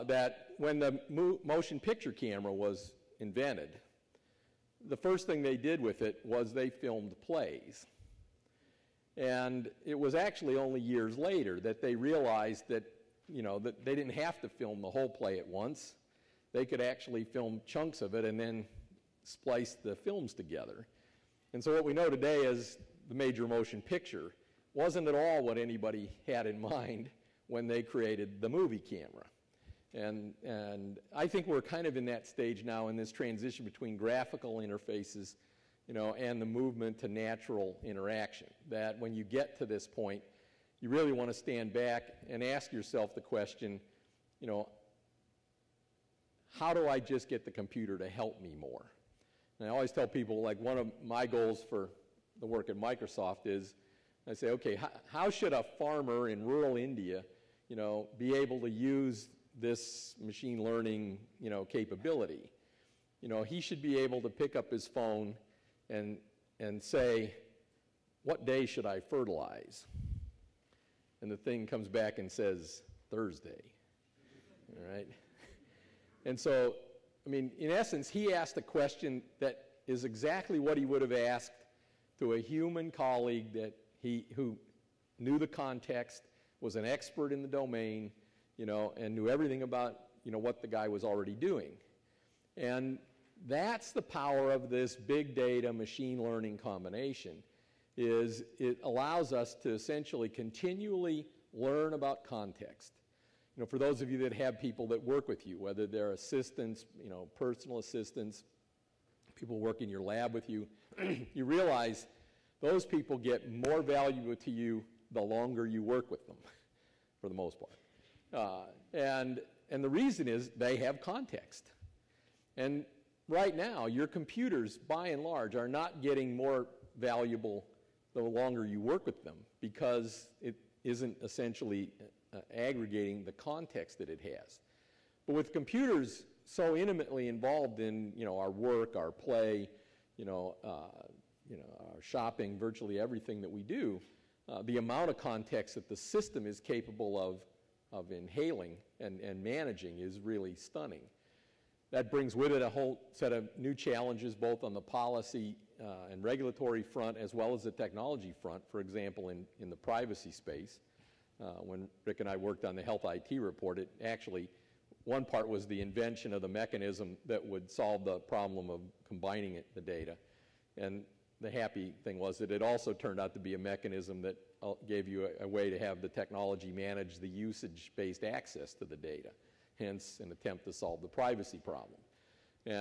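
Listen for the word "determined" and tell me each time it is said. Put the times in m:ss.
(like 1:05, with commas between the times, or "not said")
not said.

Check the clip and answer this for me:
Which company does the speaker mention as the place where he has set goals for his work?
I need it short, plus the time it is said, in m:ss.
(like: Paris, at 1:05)
Microsoft, at 0:52.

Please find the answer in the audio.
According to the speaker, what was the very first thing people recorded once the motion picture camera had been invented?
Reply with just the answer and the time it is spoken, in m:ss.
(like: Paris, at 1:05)
Plays, at 0:06.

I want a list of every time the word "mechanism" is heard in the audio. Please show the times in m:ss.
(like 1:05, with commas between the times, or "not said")
2:46, 2:53.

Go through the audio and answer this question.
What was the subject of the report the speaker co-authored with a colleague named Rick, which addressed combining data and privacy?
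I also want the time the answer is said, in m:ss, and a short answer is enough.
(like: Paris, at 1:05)
Health IT, at 2:42.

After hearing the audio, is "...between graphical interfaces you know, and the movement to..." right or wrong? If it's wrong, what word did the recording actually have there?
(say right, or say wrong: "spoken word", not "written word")
right.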